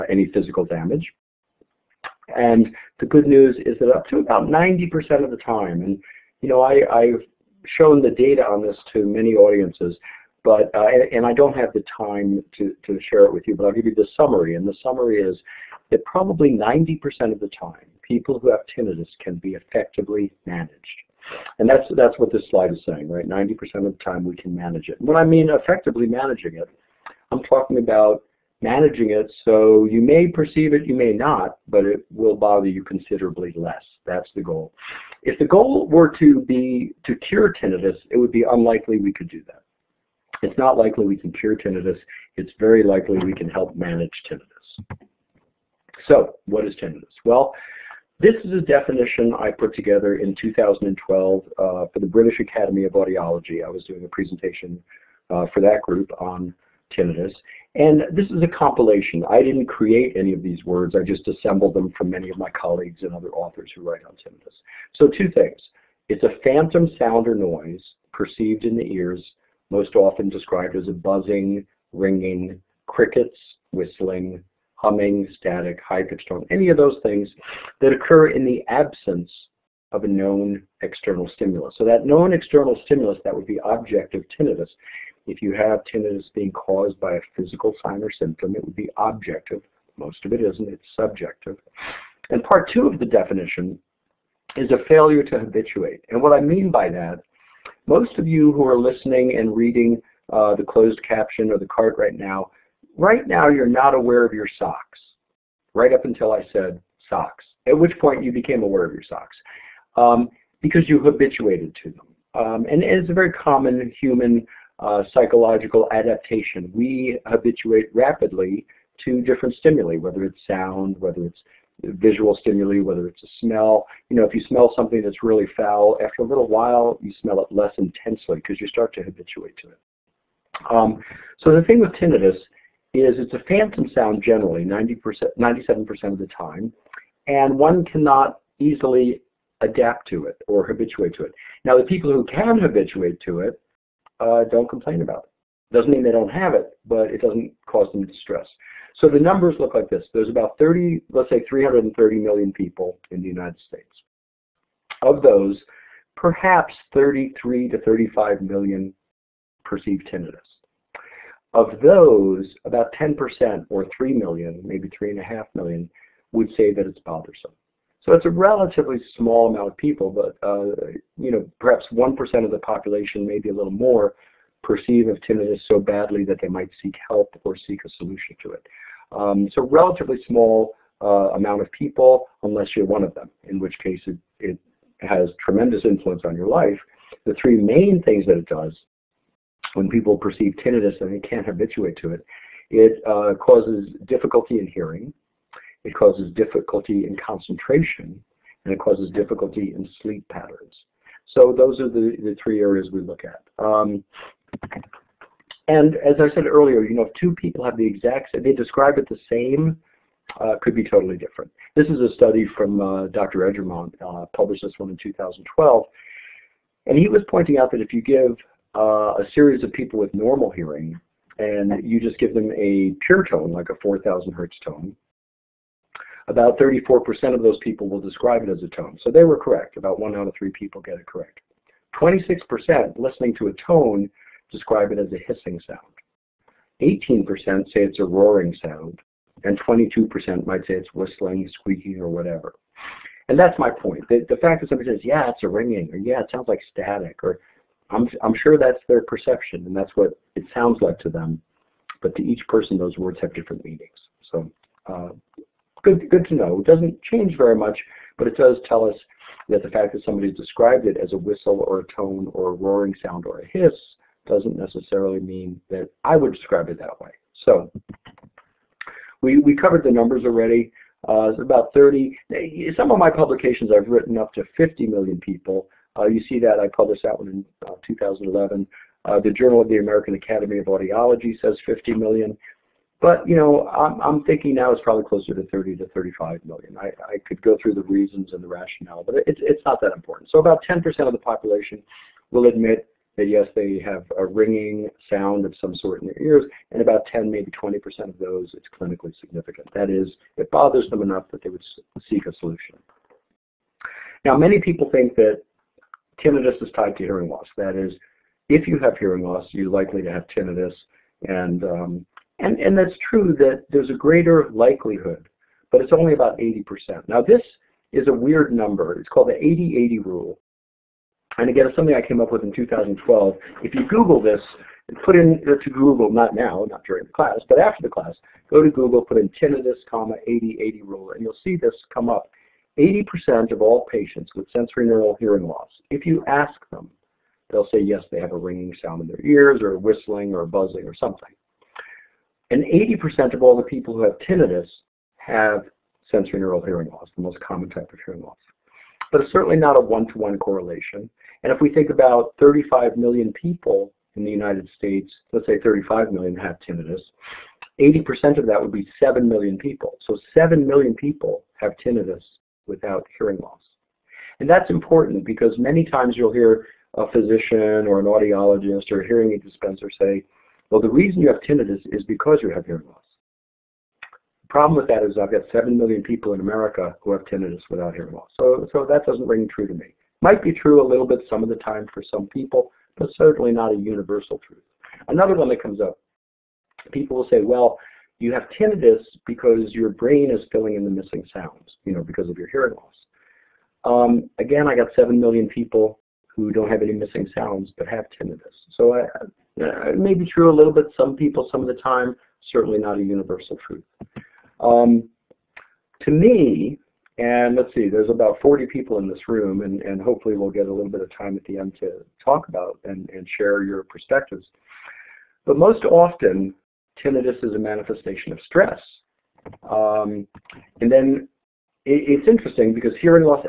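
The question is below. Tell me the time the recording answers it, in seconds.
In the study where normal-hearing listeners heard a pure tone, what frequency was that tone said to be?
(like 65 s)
223 s.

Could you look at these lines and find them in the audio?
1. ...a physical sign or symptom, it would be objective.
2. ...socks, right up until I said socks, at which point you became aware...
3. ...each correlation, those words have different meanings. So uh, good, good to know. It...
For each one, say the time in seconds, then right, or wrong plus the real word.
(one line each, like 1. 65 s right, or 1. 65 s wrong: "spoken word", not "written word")
1. 87 s right
2. 104 s right
3. 252 s wrong: "person", not "correlation".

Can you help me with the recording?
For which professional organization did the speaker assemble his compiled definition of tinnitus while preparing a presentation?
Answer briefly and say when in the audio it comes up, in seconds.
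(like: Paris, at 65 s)
British Academy of Audiology, at 52 s.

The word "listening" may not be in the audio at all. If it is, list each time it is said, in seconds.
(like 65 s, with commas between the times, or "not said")
98 s, 232 s.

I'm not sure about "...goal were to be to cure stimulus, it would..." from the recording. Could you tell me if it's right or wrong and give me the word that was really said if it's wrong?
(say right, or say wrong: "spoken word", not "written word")
wrong: "tinnitus", not "stimulus".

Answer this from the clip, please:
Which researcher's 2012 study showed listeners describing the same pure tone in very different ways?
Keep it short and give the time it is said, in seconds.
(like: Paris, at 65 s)
Eggermont, at 213 s.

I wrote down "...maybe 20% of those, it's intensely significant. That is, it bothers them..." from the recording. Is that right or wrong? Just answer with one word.
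wrong.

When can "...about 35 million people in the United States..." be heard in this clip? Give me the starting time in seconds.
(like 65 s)
351 s.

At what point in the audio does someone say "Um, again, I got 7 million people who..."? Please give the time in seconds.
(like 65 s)
393 s.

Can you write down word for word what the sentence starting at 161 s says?
Of those, about 10% or 3 million, maybe 3.5 million, would say that it's bothersome.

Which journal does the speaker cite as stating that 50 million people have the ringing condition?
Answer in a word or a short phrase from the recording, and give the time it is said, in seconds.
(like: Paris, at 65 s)
Journal of the American Academy of Audiology, at 279 s.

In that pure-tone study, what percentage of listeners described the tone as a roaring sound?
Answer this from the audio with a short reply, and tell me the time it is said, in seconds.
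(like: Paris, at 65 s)
18%, at 236 s.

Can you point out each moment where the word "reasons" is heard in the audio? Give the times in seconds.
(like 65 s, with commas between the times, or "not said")
287 s, 370 s.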